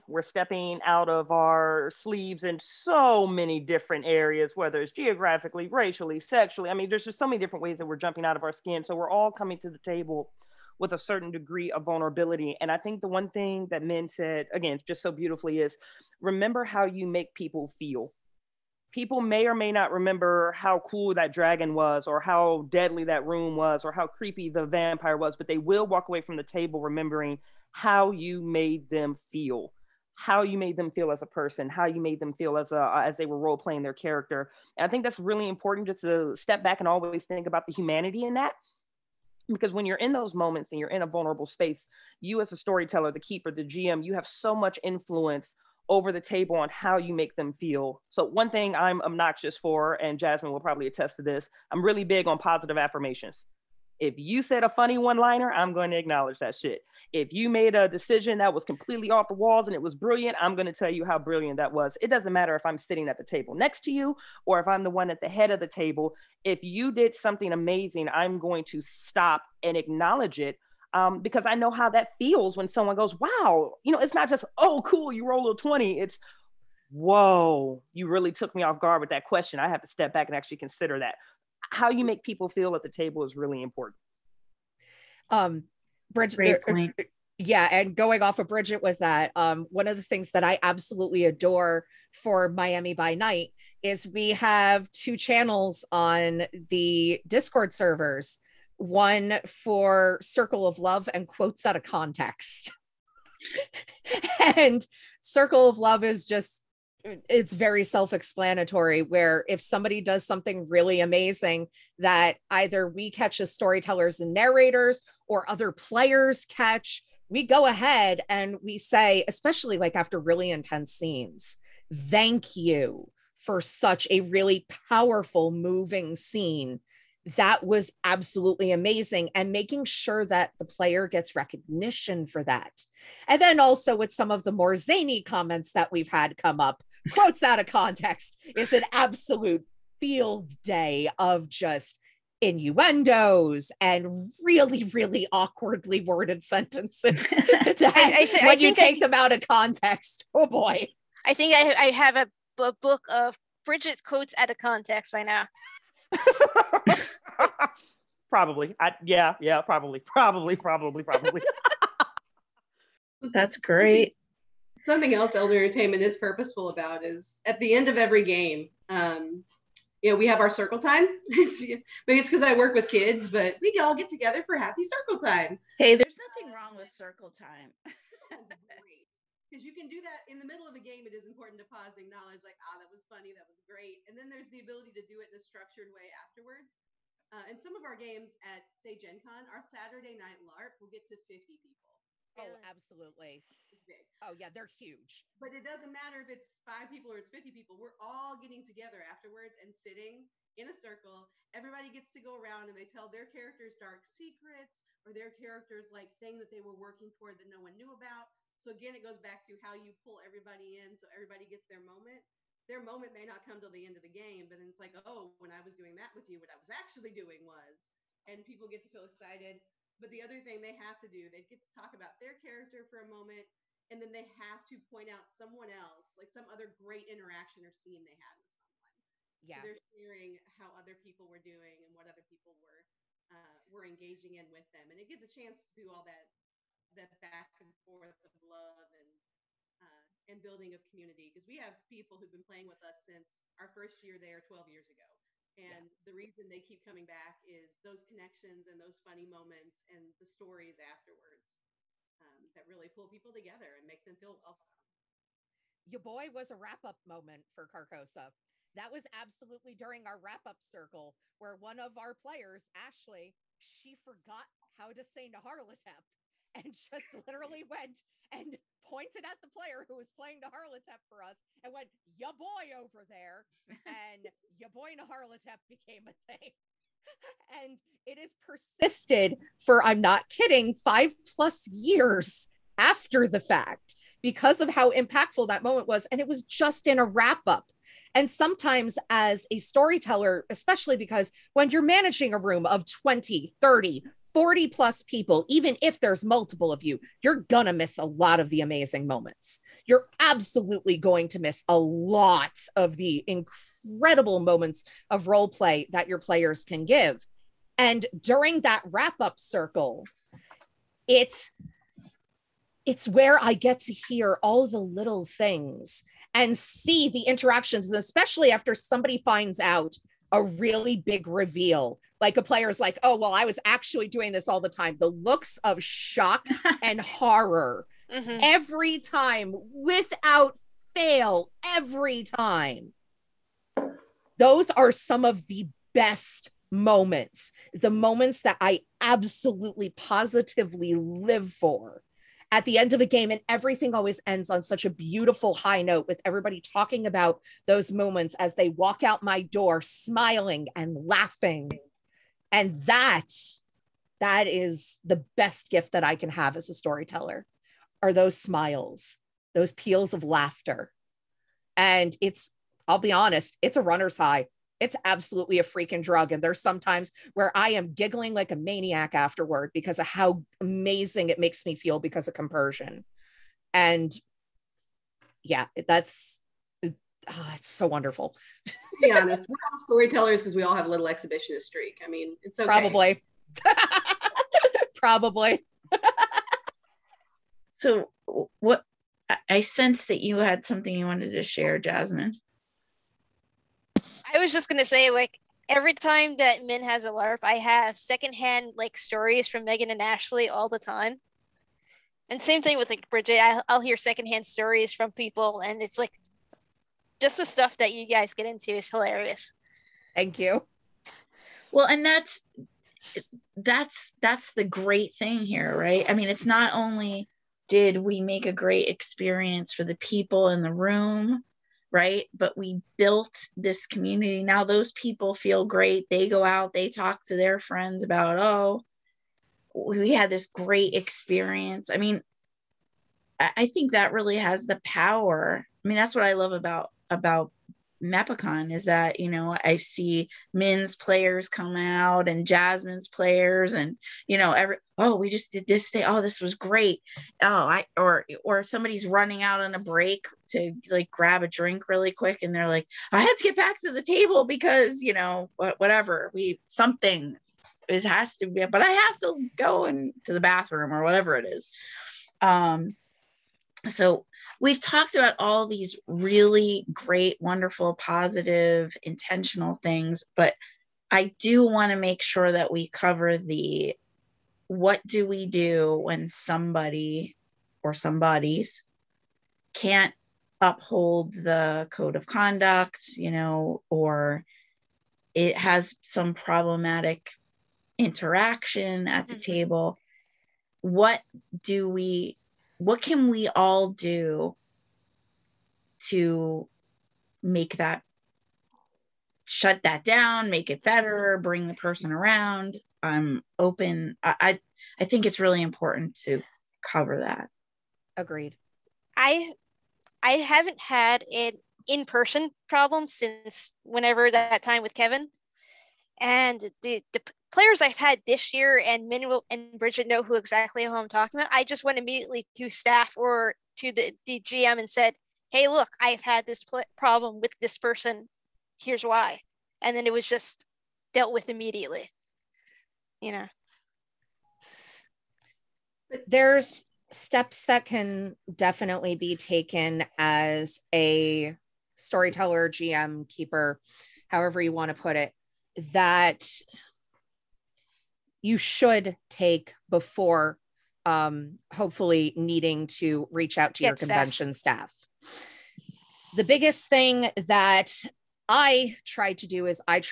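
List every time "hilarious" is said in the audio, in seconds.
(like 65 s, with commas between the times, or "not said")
408 s.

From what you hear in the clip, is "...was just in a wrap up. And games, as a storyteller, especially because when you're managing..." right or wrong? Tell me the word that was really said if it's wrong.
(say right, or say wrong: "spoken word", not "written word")
wrong: "sometimes", not "games".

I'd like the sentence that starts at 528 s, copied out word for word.
Here's why." And then it was just dealt with immediately.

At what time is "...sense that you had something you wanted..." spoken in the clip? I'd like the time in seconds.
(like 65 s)
389 s.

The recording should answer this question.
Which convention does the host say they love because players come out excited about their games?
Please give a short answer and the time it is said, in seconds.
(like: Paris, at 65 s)
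MEPACON, at 438 s.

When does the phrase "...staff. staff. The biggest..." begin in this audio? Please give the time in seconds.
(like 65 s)
554 s.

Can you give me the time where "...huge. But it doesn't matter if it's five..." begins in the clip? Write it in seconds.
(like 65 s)
194 s.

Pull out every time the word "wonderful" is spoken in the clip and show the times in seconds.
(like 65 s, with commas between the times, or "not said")
377 s, 467 s.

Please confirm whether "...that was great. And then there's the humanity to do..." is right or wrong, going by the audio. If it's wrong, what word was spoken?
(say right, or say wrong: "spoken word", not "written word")
wrong: "ability", not "humanity".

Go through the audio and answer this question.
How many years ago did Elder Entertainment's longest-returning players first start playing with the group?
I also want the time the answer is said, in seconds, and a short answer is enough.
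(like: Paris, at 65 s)
12, at 244 s.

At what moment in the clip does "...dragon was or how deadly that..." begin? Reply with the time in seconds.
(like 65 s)
21 s.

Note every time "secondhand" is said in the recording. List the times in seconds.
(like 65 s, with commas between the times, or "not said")
397 s, 403 s.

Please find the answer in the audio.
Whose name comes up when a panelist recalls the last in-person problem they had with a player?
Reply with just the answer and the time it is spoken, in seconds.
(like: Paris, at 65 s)
Kevin, at 514 s.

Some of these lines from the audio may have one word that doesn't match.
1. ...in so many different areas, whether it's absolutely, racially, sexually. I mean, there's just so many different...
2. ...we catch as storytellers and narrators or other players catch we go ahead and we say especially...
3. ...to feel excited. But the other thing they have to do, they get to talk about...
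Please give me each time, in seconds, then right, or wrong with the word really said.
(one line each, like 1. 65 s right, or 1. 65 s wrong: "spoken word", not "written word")
1. 2 s wrong: "geographically", not "absolutely"
2. 112 s right
3. 218 s right.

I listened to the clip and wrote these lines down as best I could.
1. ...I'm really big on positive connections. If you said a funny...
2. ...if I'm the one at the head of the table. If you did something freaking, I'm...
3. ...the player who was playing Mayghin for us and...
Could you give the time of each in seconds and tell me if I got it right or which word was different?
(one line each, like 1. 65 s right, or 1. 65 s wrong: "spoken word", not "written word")
1. 51 s wrong: "affirmations", not "connections"
2. 64 s wrong: "amazing", not "freaking"
3. 269 s wrong: "Nyarlathotep", not "Mayghin".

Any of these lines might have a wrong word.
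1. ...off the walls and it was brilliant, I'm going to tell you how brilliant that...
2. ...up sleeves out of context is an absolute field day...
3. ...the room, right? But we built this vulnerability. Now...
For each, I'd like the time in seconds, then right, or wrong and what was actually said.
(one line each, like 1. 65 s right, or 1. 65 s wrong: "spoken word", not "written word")
1. 59 s right
2. 136 s wrong: "quotes", not "sleeves"
3. 420 s wrong: "community", not "vulnerability".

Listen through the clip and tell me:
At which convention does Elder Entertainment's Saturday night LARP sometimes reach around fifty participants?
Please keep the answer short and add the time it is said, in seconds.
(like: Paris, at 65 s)
Gen Con, at 188 s.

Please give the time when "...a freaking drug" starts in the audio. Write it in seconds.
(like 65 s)
365 s.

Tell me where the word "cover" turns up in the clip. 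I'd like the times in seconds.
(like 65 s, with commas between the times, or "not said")
472 s, 506 s.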